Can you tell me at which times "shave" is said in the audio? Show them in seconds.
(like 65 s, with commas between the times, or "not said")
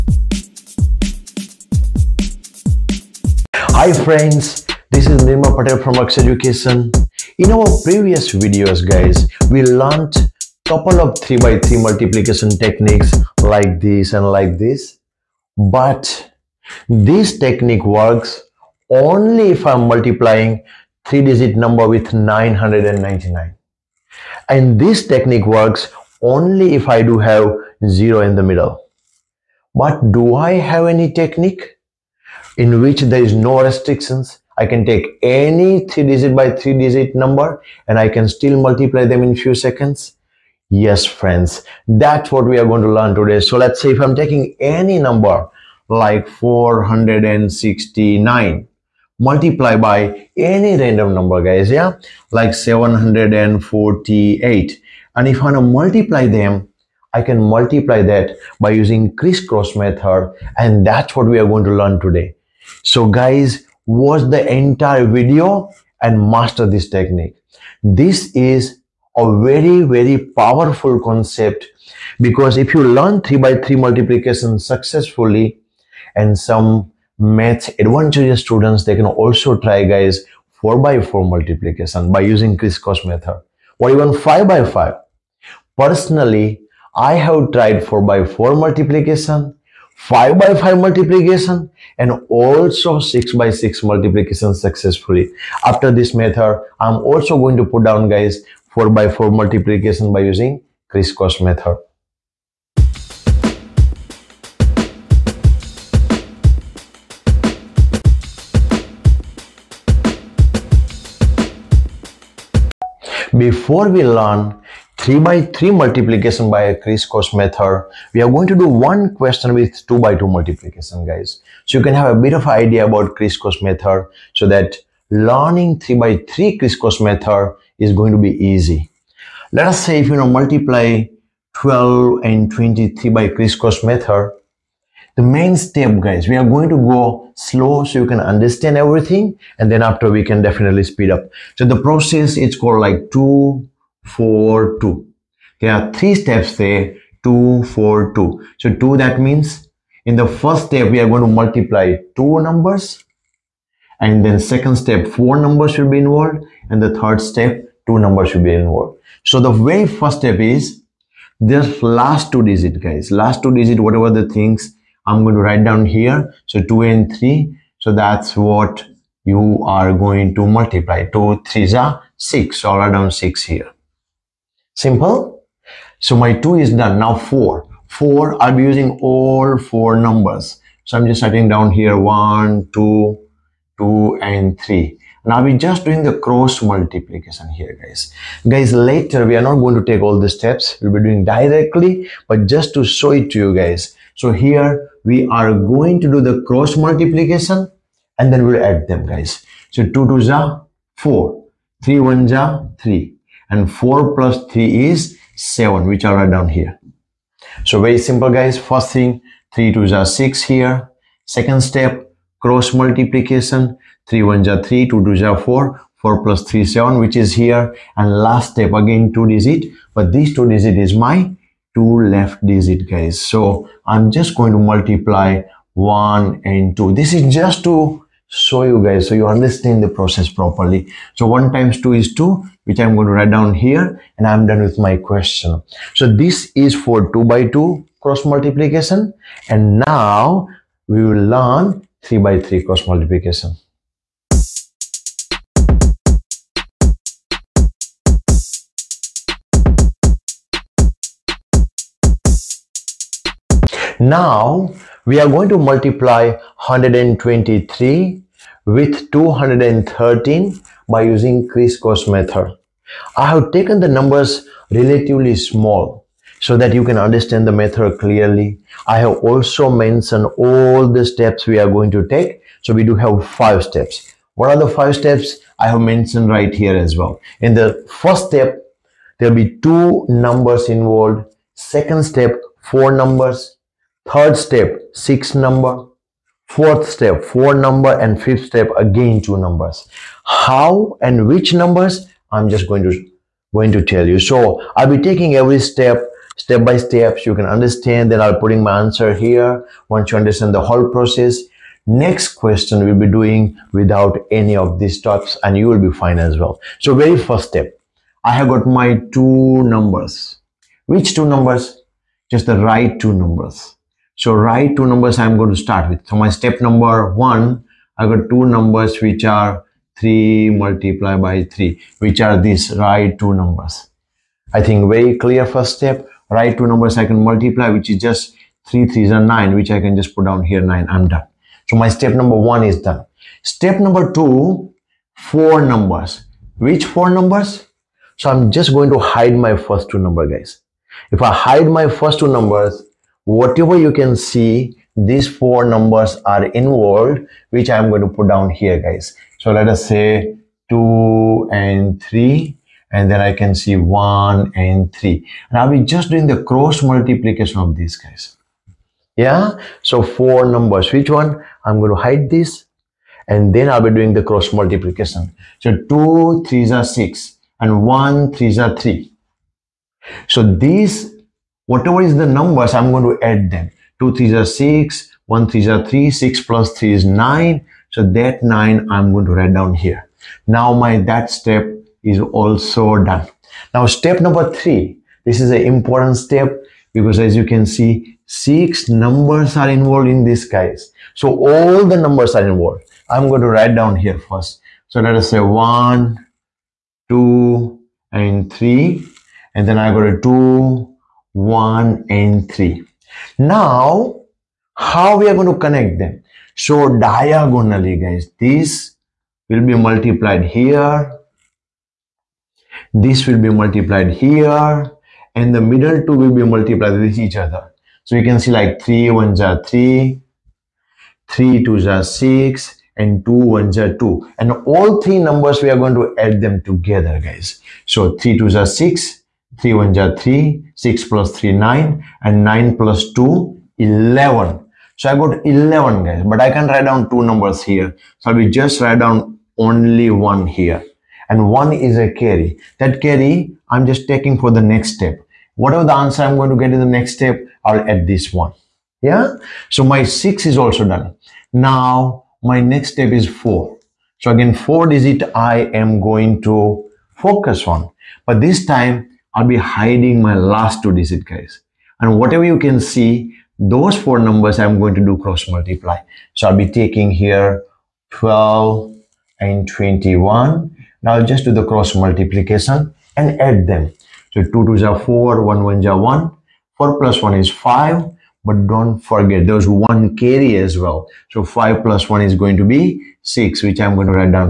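not said.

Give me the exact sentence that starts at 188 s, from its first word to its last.
Guys, later we are not going to take all the steps.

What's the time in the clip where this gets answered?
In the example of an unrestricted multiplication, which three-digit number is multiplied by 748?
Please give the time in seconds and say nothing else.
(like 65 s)
46 s.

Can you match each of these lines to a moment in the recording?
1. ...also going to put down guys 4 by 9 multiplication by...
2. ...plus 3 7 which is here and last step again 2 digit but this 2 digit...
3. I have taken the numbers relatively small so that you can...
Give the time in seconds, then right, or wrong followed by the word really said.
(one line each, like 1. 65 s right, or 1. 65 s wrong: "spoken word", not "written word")
1. 96 s wrong: "4", not "9"
2. 216 s right
3. 263 s right.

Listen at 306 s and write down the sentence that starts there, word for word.
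So very first step, I have got my two numbers.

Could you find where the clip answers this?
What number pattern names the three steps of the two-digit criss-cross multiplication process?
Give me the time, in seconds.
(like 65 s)
143 s.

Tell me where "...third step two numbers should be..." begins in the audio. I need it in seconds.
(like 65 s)
156 s.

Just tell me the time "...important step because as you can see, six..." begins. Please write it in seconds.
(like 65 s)
385 s.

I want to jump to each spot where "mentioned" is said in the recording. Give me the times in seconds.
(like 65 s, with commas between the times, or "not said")
269 s, 275 s.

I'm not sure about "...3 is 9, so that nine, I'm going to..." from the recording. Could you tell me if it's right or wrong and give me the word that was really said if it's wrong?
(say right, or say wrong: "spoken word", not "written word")
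right.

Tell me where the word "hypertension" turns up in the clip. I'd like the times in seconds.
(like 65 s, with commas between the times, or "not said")
not said.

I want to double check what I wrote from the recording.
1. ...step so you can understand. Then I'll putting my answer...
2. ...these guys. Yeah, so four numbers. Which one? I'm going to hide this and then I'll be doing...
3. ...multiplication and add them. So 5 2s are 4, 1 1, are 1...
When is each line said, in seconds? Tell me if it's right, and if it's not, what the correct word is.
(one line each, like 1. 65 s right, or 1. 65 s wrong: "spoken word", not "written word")
1. 296 s right
2. 357 s right
3. 471 s wrong: "2", not "5".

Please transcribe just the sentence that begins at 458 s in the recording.
But this time I'll be hiding my last two digit guys.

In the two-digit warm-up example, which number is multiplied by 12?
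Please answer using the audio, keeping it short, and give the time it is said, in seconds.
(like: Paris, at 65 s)
23, at 132 s.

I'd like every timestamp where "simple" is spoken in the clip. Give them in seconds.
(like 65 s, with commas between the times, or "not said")
174 s, 207 s.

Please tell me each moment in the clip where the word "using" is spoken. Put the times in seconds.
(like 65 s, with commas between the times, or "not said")
58 s, 82 s, 100 s, 178 s, 261 s.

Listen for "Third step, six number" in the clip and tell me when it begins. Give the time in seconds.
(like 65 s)
284 s.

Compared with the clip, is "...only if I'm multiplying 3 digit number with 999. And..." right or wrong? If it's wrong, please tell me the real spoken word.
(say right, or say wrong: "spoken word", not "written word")
right.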